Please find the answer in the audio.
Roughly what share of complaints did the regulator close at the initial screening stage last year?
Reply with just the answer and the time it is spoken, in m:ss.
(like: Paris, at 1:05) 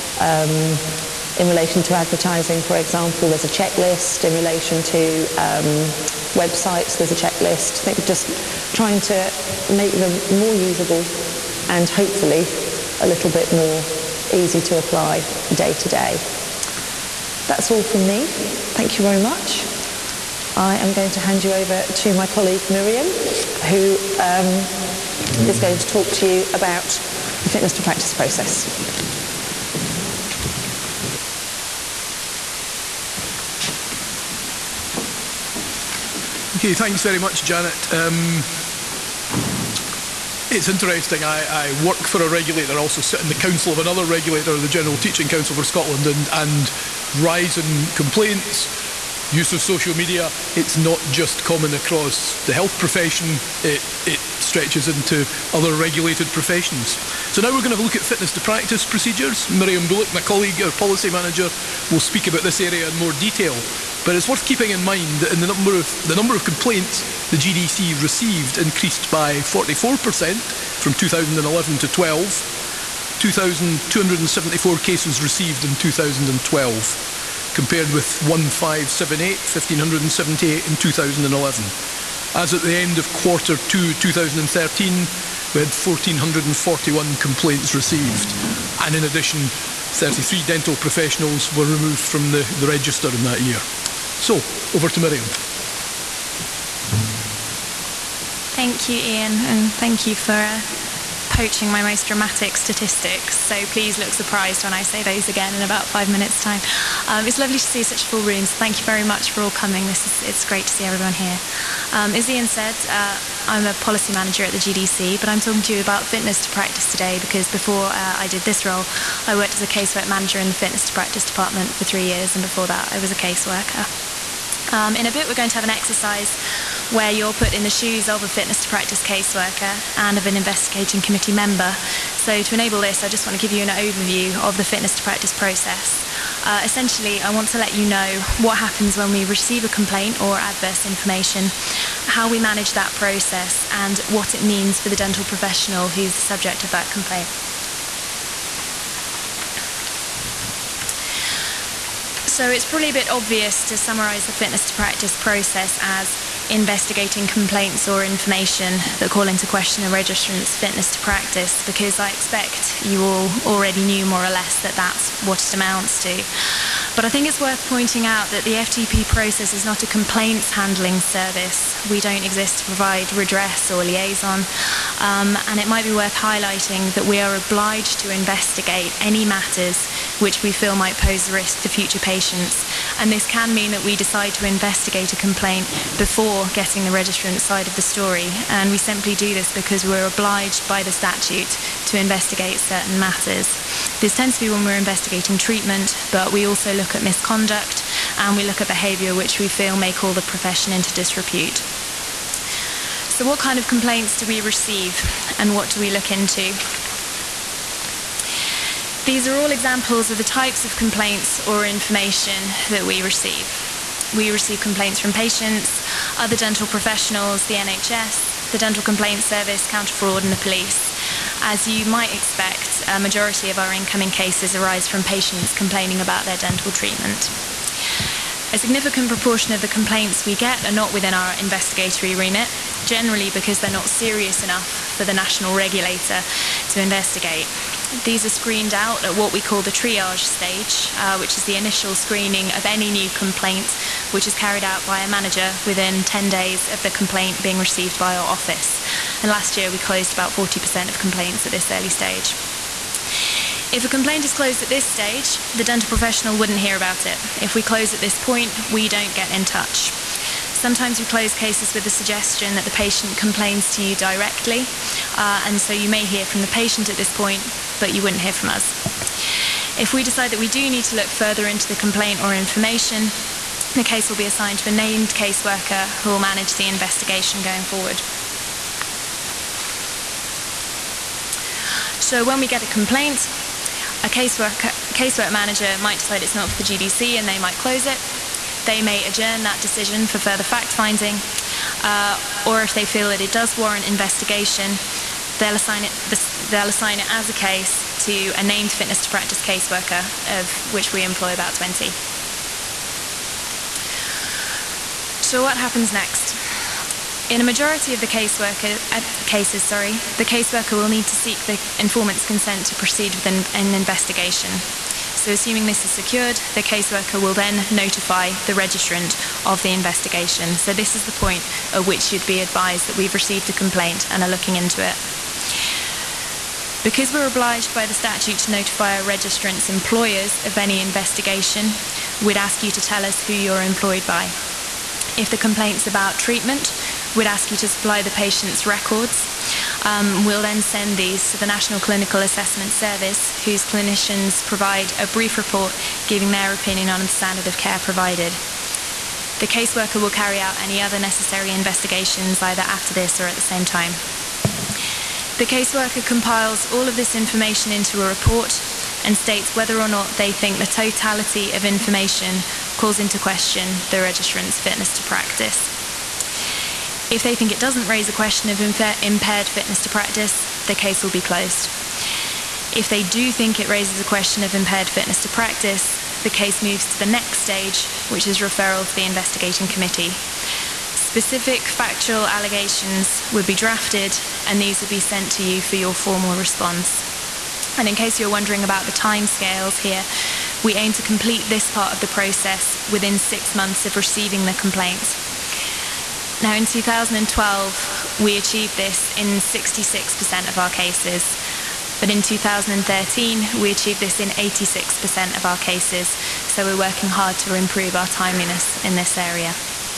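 40%, at 4:10.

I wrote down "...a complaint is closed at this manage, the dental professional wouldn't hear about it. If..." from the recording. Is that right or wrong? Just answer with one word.
wrong.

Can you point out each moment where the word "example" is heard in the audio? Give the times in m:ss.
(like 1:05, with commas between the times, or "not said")
0:02, 3:29.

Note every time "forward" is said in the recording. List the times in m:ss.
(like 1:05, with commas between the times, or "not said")
4:37.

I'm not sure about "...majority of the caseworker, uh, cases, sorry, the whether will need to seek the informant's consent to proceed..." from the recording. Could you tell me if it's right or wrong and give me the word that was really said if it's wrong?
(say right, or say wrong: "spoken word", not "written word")
wrong: "caseworker", not "whether".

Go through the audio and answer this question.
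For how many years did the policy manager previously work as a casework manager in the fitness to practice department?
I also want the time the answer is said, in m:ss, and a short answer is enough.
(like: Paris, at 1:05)
3, at 2:01.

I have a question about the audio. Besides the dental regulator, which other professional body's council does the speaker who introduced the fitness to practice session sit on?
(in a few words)
General Teaching Council for Scotland.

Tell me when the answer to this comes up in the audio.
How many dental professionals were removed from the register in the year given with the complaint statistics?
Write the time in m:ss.
1:29.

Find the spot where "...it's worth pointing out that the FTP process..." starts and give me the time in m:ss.
2:47.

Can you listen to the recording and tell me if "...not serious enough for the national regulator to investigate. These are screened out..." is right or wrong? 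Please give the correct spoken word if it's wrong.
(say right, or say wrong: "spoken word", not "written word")
right.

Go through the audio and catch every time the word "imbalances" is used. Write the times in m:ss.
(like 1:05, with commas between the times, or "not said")
not said.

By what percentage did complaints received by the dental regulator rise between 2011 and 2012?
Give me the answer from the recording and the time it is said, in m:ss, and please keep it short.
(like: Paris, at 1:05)
44%, at 1:09.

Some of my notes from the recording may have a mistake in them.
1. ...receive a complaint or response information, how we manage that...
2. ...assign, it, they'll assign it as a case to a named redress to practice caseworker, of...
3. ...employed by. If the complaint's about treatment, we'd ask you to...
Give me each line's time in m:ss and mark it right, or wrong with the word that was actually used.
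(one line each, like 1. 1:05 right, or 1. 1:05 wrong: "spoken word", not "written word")
1. 2:19 wrong: "adverse", not "response"
2. 4:55 wrong: "fitness", not "redress"
3. 5:33 right.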